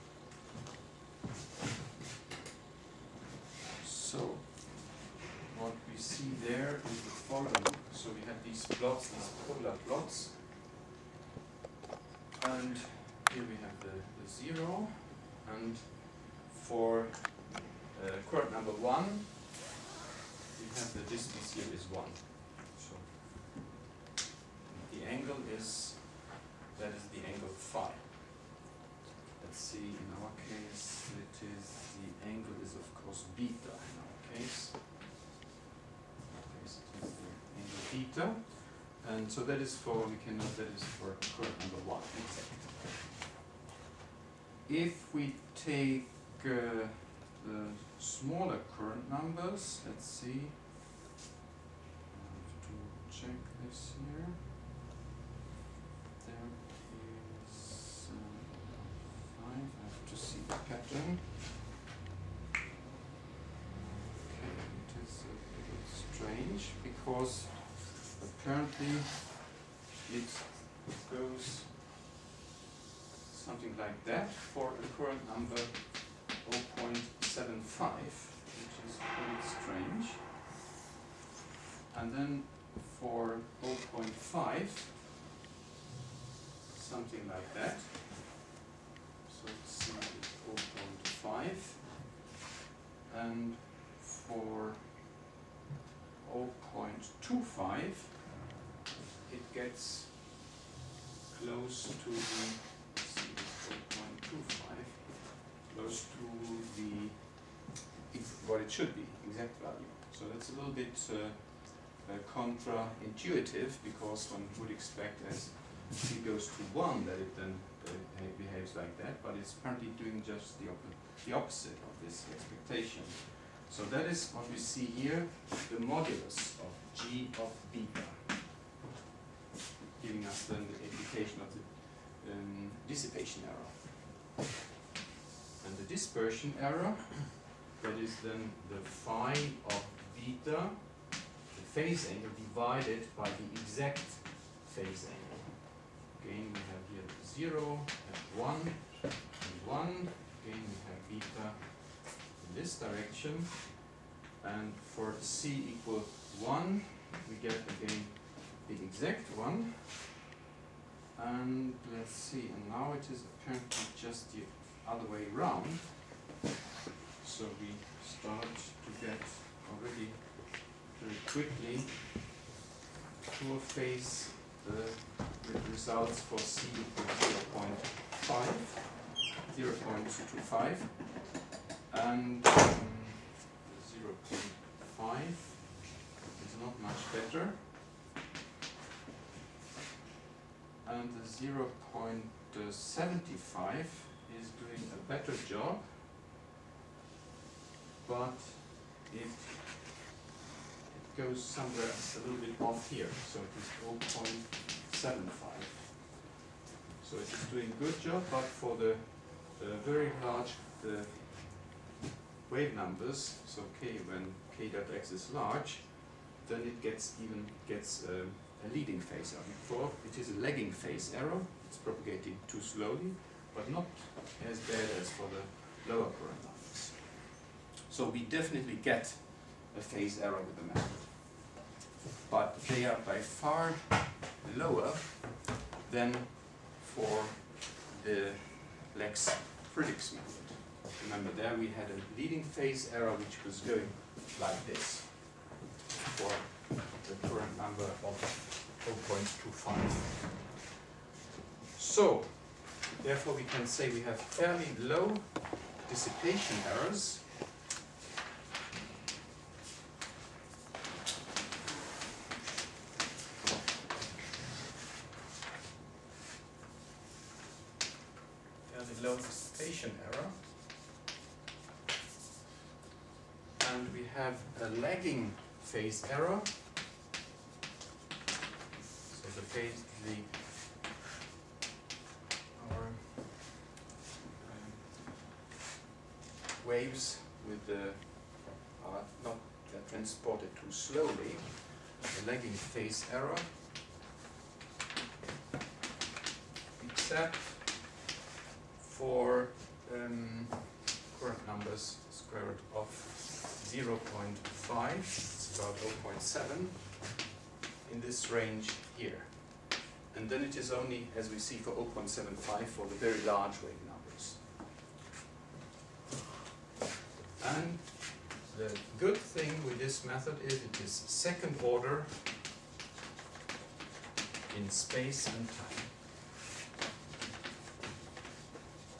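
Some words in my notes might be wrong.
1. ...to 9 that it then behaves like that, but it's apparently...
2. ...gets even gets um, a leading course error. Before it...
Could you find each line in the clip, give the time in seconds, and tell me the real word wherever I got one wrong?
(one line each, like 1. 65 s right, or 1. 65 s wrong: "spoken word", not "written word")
1. 116 s wrong: "1", not "9"
2. 216 s wrong: "phase", not "course".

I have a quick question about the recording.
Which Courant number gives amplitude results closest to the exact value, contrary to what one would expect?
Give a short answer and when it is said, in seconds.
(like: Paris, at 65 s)
0.25, at 103 s.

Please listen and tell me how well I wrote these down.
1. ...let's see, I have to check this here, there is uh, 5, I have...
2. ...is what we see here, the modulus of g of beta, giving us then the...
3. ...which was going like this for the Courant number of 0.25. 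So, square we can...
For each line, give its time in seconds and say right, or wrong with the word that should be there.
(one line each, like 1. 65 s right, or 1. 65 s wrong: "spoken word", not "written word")
1. 49 s right
2. 124 s right
3. 243 s wrong: "therefore", not "square".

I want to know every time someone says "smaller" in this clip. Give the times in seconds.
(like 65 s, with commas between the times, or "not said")
47 s.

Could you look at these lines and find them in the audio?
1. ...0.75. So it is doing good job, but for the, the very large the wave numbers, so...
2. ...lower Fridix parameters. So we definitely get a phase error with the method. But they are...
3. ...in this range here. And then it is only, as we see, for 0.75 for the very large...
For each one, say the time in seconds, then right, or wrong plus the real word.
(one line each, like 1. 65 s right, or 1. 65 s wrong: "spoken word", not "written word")
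1. 205 s right
2. 225 s wrong: "Courant", not "Fridix"
3. 307 s right.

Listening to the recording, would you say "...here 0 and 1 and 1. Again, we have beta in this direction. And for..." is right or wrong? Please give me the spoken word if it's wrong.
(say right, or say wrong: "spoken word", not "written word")
right.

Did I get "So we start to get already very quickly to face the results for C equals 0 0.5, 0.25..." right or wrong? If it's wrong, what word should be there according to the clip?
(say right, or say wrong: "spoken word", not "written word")
right.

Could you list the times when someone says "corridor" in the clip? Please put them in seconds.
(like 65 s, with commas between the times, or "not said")
not said.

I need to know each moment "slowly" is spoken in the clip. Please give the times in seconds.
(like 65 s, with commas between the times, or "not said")
222 s, 290 s.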